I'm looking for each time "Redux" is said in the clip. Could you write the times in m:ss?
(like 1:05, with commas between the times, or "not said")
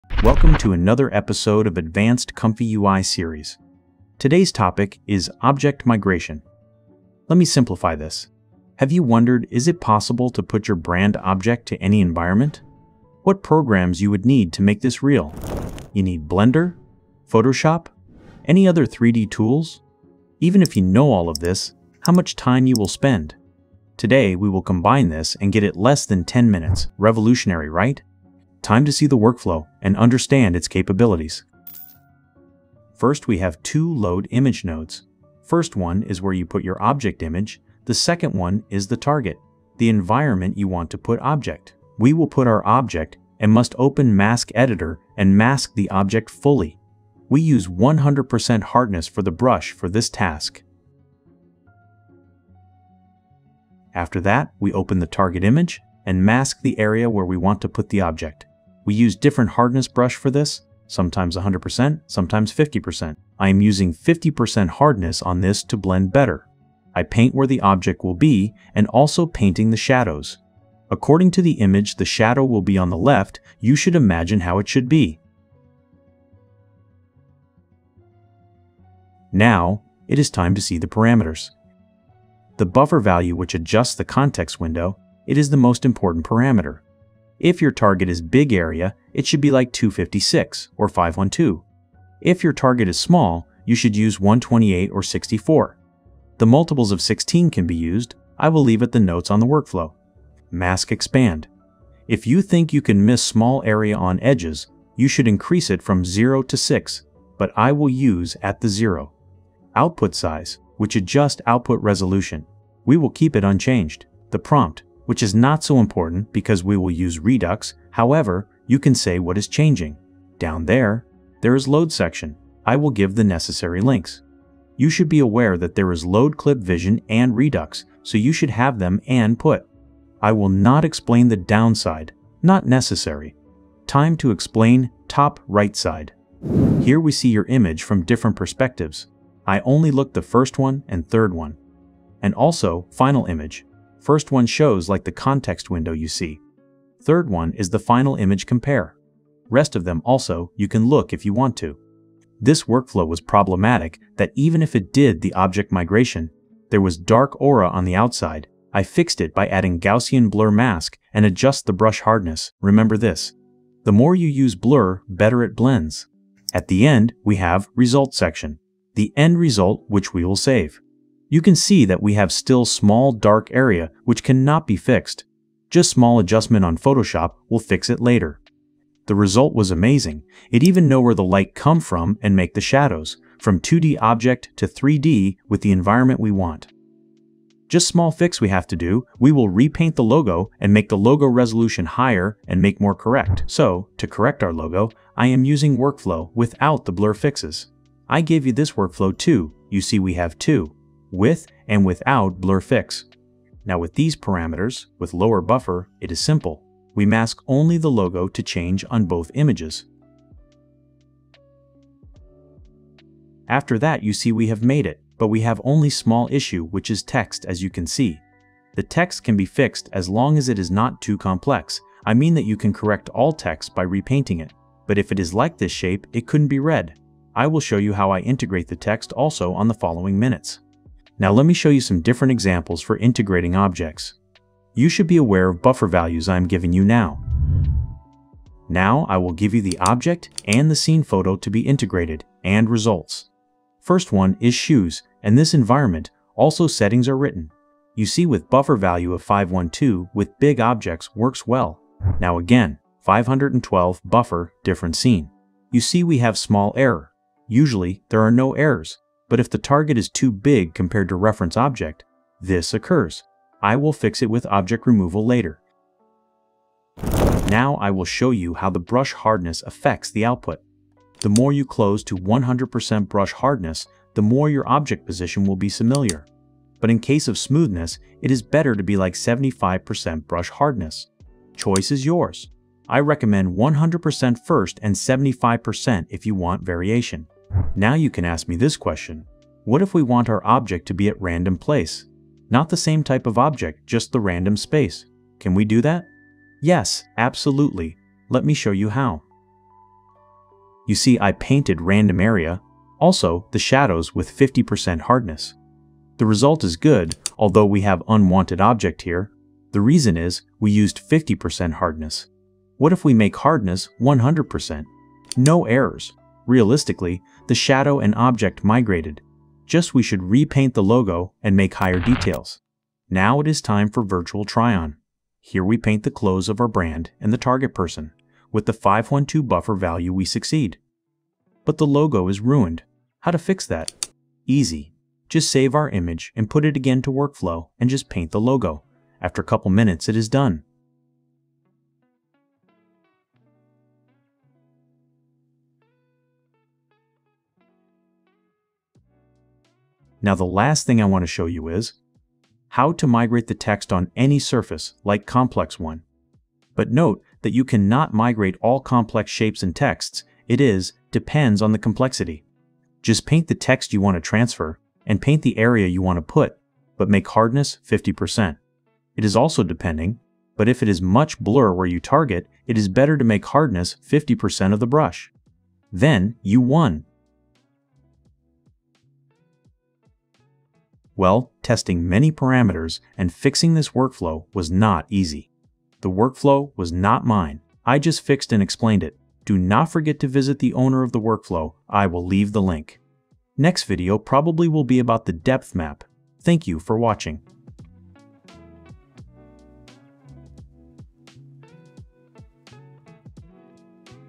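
1:57, 2:07.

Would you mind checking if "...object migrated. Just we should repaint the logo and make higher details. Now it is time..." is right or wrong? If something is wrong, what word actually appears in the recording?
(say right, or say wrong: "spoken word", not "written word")
right.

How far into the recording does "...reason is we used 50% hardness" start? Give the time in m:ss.
5:09.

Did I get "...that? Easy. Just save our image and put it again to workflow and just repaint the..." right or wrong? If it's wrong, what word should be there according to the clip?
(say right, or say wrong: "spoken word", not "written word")
wrong: "paint", not "repaint".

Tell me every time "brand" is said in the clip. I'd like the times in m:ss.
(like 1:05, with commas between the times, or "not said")
0:10, 5:26.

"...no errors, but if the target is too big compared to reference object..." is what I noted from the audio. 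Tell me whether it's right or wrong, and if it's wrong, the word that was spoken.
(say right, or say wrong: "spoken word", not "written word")
right.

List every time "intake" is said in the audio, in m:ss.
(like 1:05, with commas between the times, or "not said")
not said.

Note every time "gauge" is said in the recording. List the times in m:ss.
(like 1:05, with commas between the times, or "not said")
not said.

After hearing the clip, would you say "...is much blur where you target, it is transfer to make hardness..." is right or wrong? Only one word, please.
wrong.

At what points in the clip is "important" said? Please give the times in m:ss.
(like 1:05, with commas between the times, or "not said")
1:25, 1:55.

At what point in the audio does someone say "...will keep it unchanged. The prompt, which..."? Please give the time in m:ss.
1:52.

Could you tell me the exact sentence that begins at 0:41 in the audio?
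We will put our object and must open Mask Editor and mask the object fully.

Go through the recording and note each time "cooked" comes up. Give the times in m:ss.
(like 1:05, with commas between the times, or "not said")
not said.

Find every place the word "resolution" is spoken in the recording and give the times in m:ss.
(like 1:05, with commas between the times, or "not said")
1:51, 3:11.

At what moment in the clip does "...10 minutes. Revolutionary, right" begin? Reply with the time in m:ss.
0:26.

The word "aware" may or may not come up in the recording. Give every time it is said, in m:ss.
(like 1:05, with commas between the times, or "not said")
2:05, 3:55.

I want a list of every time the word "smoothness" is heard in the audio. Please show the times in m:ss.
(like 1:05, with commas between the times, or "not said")
4:37.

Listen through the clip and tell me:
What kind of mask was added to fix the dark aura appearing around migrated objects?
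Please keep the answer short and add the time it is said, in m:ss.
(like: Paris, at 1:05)
Gaussian blur mask, at 2:39.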